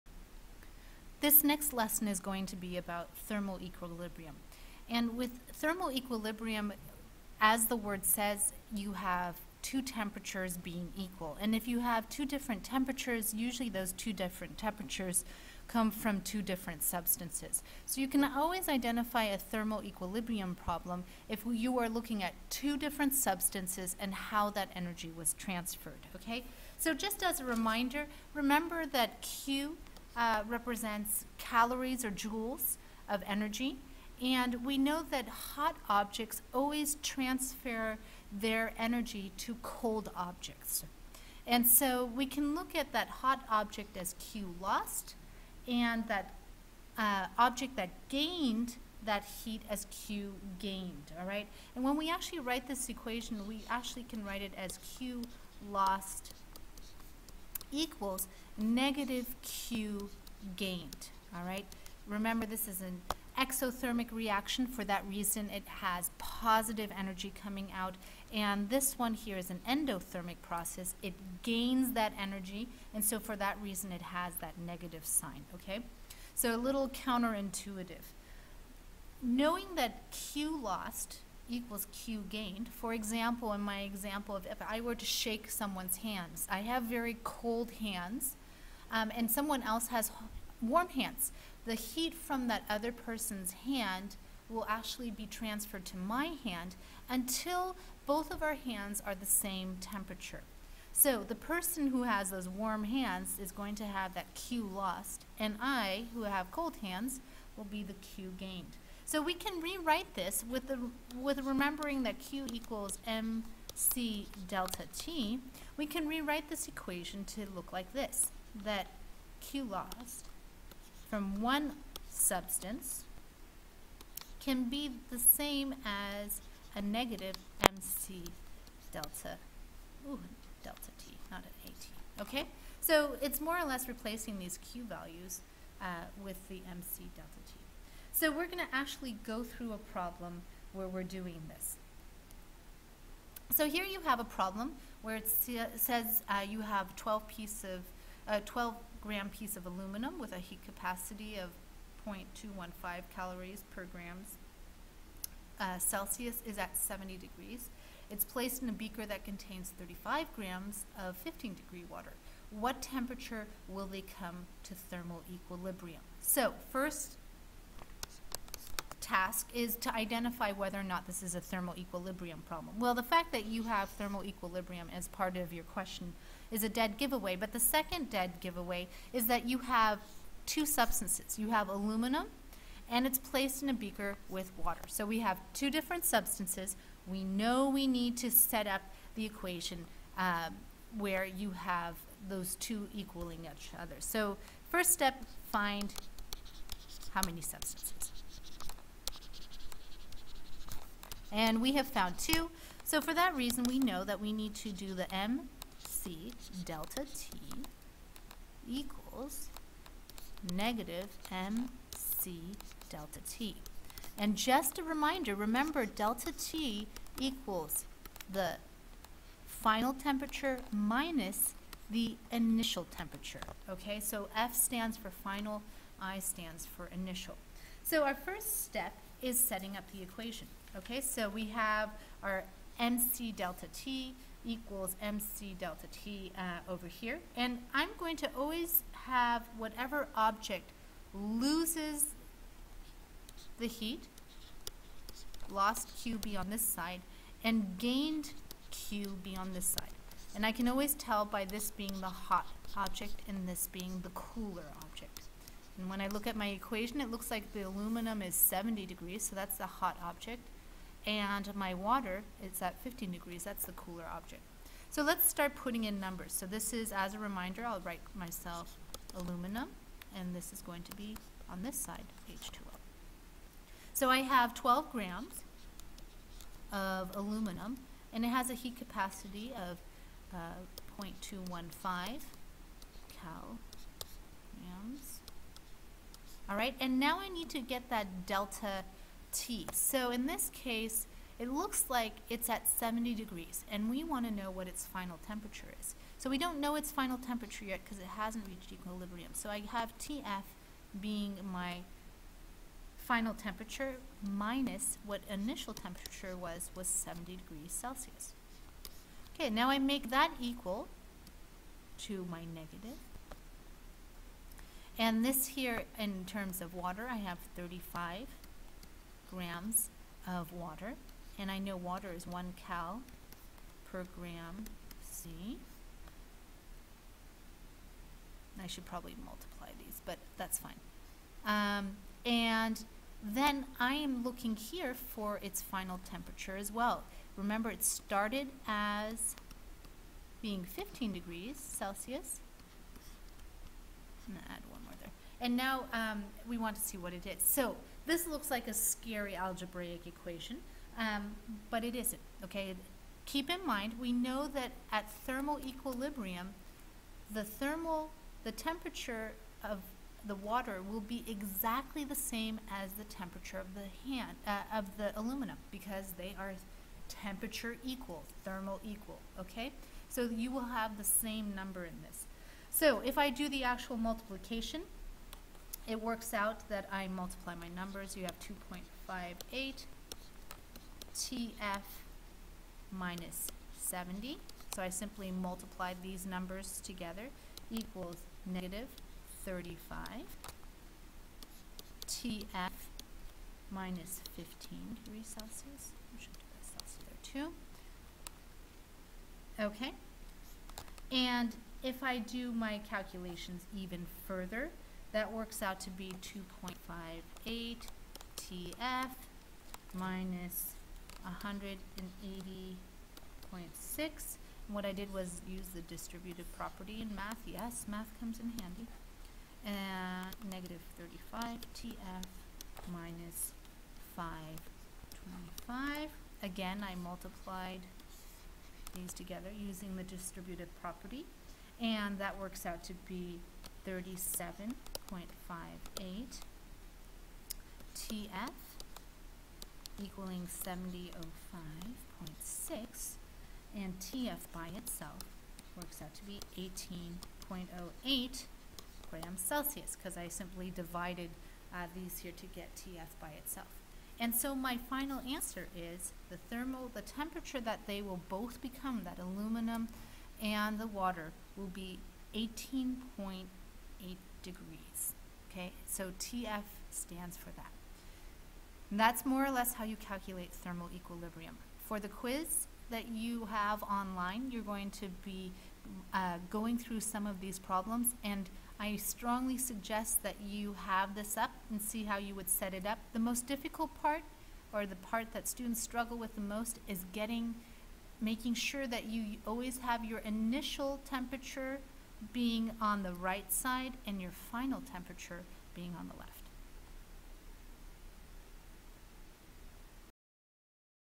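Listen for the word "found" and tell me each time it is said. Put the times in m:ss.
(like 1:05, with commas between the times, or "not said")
3:21.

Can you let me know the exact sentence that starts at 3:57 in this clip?
And I'm going to always have whatever object loses the heat, lost QB on this side, and gained QB on this side.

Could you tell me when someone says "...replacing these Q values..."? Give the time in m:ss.
2:13.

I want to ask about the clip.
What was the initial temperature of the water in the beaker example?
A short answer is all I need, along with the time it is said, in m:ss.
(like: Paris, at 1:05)
15 degrees, at 2:41.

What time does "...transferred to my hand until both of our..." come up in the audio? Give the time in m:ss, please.
1:35.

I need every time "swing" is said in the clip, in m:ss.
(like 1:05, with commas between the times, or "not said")
not said.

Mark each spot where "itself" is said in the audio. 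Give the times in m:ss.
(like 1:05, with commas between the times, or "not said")
7:24, 7:33.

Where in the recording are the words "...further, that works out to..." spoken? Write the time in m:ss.
6:44.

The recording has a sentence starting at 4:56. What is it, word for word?
So we don't know its final temperature yet because it hasn't reached equilibrium.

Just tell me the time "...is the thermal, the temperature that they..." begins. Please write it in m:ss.
7:35.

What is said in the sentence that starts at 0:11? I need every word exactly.
And if you have two different temperatures, usually those two different temperatures come from two different substances.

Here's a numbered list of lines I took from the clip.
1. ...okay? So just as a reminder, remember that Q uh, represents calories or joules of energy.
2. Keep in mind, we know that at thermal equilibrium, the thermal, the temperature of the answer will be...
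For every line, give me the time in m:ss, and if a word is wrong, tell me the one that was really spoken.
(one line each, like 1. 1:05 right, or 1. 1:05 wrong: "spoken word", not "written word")
1. 0:26 right
2. 5:53 wrong: "water", not "answer".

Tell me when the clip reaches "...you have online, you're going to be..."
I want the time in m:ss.
7:53.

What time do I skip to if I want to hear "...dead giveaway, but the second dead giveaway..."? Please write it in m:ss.
2:56.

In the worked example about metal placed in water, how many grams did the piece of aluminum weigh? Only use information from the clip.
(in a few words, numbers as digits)
12 grams.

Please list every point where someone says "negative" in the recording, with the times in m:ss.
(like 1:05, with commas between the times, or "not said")
0:58, 1:14, 2:06, 3:30, 5:12, 6:28, 7:00.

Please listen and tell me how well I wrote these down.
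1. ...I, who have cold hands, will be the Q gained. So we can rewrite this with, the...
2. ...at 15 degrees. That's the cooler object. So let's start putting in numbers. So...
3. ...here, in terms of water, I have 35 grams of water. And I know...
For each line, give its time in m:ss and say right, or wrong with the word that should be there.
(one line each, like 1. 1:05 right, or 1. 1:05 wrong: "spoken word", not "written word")
1. 1:45 right
2. 4:22 right
3. 5:15 right.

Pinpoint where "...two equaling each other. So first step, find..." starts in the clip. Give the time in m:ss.
3:12.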